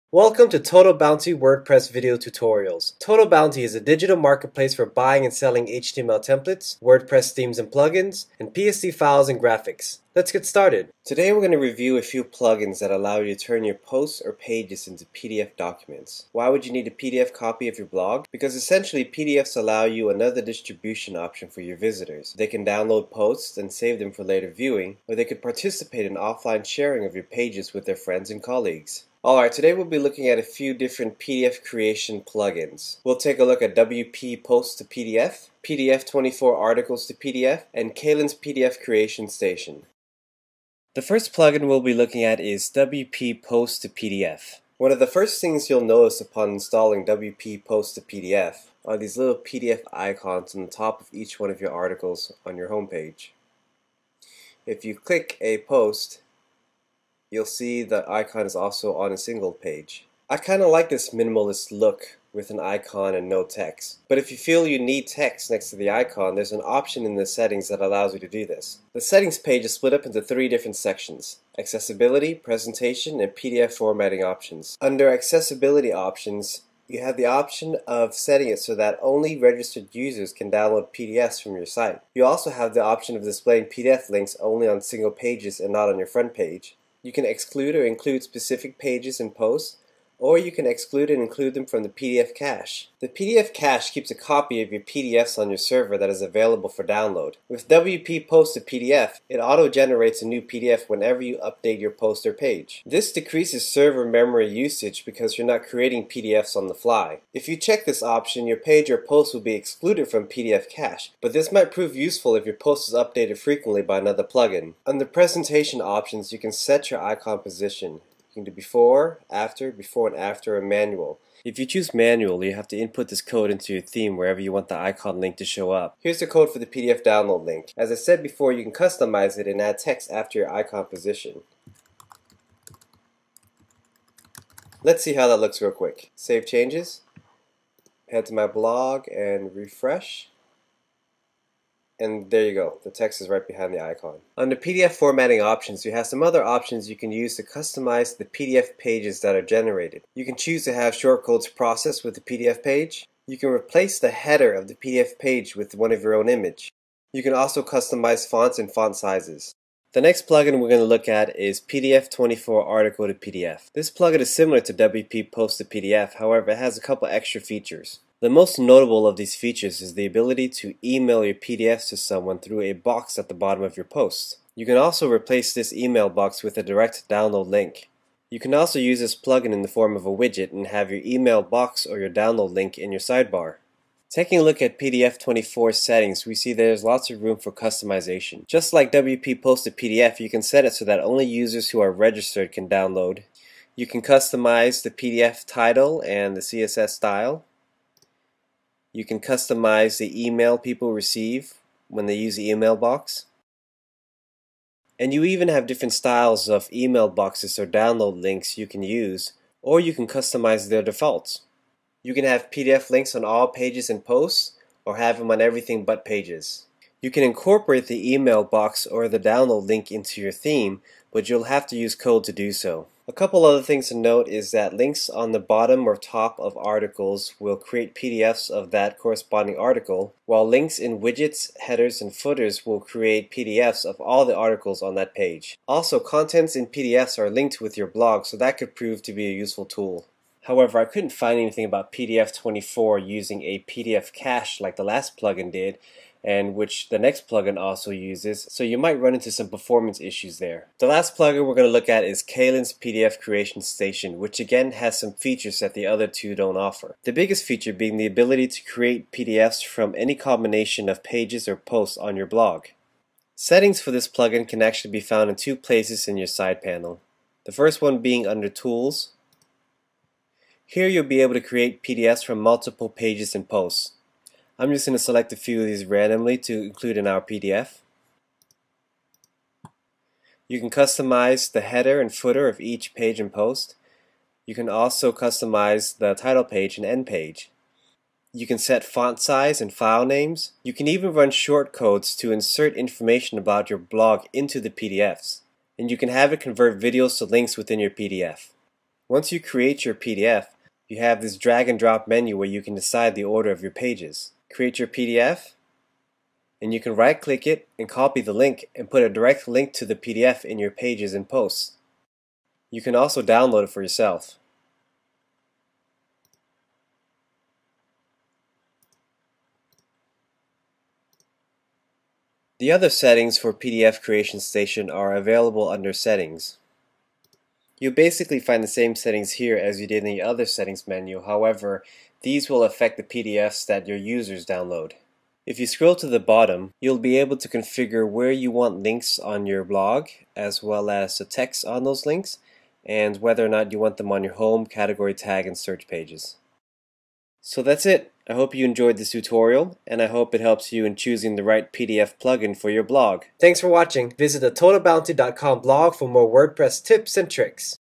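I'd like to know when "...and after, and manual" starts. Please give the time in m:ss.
2:00.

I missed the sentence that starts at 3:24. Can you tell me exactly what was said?
And you even have different styles of email boxes or download links you can use, or you can customize their defaults.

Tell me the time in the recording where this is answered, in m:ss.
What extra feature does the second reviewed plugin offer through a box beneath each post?
2:50.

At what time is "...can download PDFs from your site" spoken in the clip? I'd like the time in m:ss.
1:20.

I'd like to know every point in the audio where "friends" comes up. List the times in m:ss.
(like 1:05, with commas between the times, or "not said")
0:27.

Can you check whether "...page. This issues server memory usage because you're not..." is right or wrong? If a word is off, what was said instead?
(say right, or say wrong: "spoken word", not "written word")
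wrong: "decreases", not "issues".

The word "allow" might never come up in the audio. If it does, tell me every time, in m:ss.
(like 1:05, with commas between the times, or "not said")
0:12, 0:19, 1:07.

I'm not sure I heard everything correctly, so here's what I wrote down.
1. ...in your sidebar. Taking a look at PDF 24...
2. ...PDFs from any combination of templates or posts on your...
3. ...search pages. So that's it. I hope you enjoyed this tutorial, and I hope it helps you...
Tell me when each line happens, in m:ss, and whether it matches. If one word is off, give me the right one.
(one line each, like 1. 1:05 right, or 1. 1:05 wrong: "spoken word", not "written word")
1. 3:02 right
2. 4:19 wrong: "pages", not "templates"
3. 5:45 right.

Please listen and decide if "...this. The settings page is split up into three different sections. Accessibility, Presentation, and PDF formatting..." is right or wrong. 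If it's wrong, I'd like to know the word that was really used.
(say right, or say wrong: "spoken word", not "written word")
right.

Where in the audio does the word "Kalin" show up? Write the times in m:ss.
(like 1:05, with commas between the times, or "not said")
0:37, 4:12.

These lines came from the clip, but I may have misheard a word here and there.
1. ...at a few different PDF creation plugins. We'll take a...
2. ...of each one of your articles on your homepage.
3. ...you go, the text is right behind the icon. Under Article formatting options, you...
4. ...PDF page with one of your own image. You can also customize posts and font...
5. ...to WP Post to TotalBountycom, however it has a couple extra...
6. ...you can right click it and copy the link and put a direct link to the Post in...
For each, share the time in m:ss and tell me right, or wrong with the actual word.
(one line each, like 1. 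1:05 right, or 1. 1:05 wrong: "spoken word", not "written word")
1. 0:30 right
2. 0:50 right
3. 2:22 wrong: "PDF", not "Article"
4. 2:34 wrong: "fonts", not "posts"
5. 2:44 wrong: "PDF", not "TotalBountycom"
6. 5:06 wrong: "PDF", not "Post".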